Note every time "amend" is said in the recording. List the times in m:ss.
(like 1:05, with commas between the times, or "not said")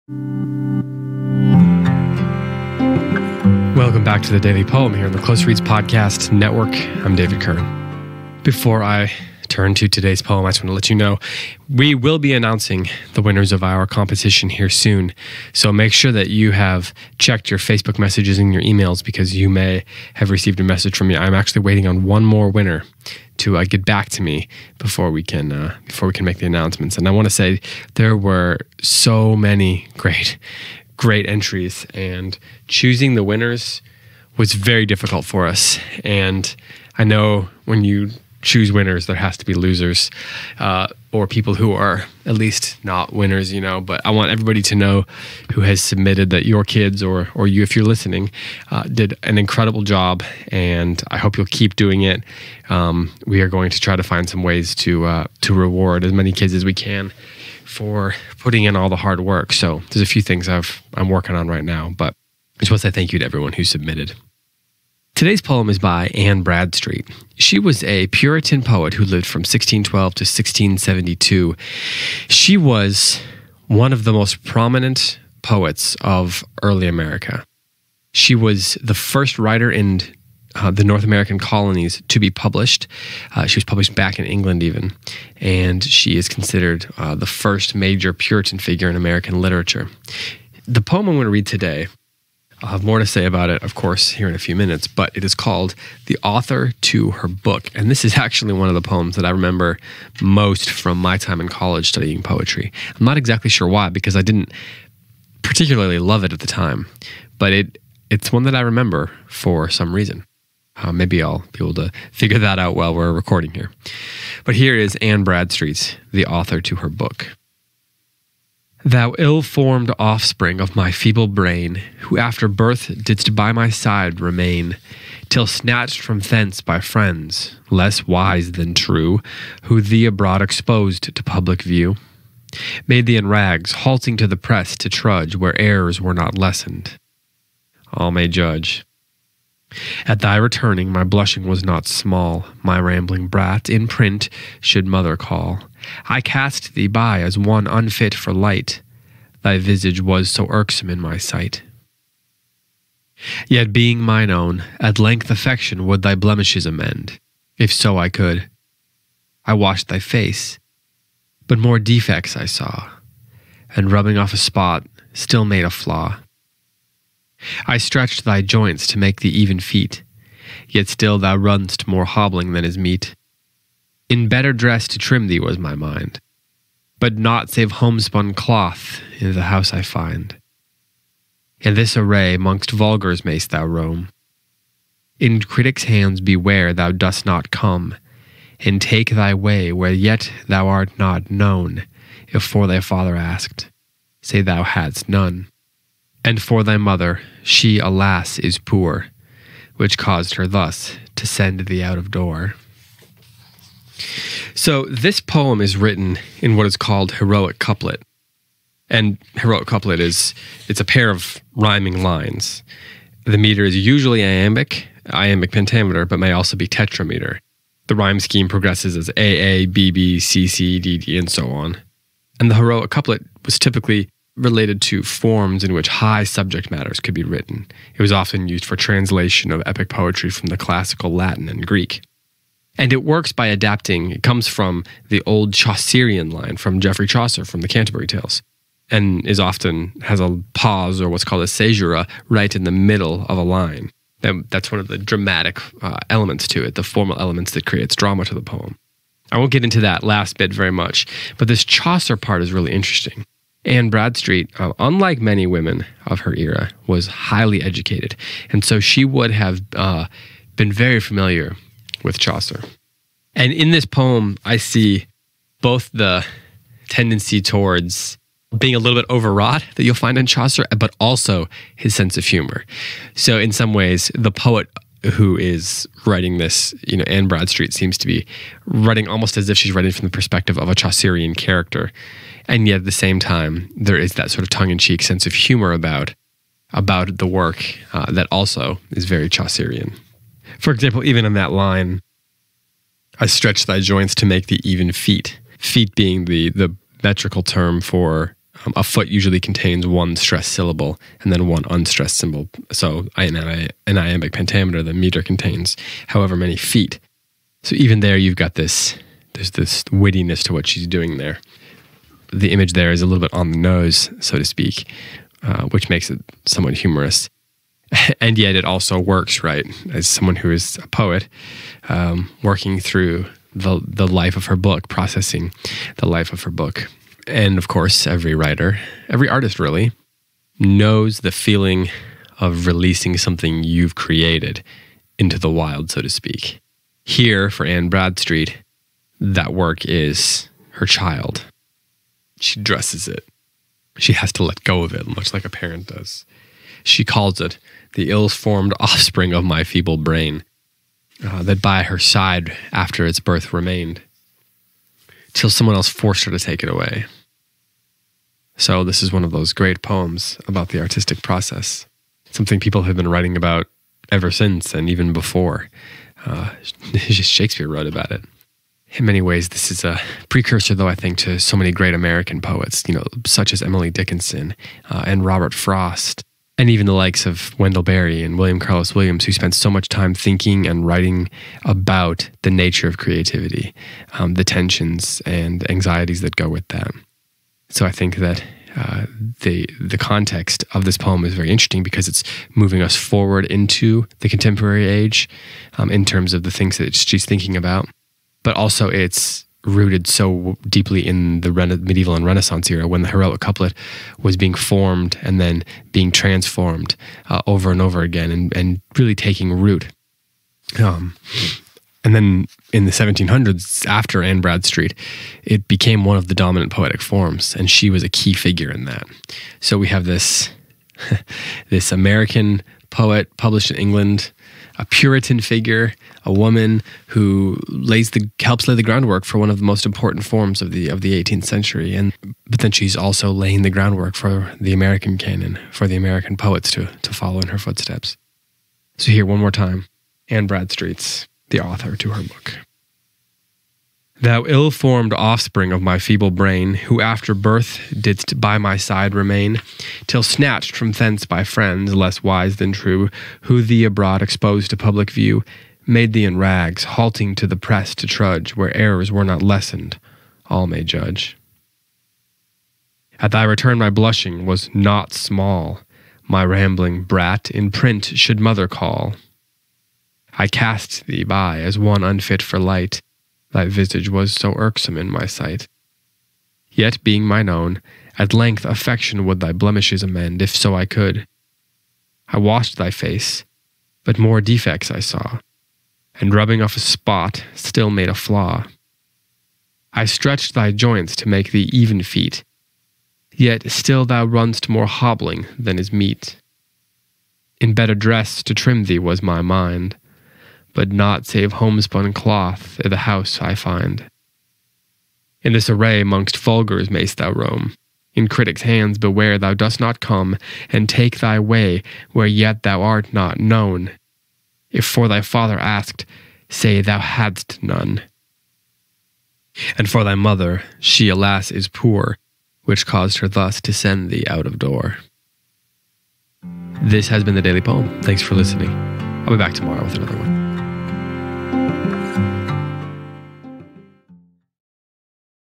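2:36, 8:00.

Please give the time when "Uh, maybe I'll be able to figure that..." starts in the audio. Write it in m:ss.
1:50.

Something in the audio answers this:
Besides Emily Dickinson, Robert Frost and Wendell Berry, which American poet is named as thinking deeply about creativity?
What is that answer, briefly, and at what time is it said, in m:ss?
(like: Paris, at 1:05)
William Carlos Williams, at 6:18.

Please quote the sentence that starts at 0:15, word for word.
So make sure that you have checked your Facebook messages and your emails because you may have received a message from me.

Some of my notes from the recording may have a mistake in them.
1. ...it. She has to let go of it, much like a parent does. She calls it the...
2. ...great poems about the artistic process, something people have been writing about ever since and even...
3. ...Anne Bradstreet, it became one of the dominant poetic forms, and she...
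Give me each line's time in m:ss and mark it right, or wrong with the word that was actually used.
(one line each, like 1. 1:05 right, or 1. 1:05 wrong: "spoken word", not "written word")
1. 5:43 right
2. 5:59 right
3. 6:54 right.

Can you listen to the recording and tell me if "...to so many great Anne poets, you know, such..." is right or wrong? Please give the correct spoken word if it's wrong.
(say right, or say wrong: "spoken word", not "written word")
wrong: "American", not "Anne".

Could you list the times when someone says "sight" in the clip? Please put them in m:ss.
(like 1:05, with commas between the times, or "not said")
2:31, 7:55.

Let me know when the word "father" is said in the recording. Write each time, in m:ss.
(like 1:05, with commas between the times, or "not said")
3:12, 8:35.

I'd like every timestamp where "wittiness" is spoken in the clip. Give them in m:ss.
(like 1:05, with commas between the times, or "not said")
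5:09.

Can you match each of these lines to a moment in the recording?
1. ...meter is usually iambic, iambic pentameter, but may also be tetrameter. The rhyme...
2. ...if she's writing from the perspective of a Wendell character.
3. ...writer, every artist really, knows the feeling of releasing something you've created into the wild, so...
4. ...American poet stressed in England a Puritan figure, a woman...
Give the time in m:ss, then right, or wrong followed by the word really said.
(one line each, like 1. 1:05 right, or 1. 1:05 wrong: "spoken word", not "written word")
1. 3:33 right
2. 4:39 wrong: "Chaucerian", not "Wendell"
3. 5:28 right
4. 7:01 wrong: "published", not "stressed".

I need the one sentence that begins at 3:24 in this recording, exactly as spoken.
So, this poem is written in what is called heroic couplet.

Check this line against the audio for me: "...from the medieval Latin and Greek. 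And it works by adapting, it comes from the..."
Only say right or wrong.
wrong.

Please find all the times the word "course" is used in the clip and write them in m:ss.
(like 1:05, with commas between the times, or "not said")
1:33, 5:27.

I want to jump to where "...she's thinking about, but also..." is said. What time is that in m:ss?
6:36.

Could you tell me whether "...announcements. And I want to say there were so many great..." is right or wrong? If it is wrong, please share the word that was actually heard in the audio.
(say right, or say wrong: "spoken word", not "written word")
right.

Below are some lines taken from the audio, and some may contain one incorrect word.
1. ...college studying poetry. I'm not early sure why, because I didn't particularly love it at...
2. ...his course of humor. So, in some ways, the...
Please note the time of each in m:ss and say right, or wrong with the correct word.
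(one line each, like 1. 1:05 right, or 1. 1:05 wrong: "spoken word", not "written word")
1. 1:41 wrong: "exactly", not "early"
2. 4:31 wrong: "sense", not "course".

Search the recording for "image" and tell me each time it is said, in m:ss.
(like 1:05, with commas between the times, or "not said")
5:12.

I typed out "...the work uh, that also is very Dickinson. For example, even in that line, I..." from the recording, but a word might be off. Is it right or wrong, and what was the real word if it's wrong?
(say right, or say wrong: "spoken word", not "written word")
wrong: "Chaucerian", not "Dickinson".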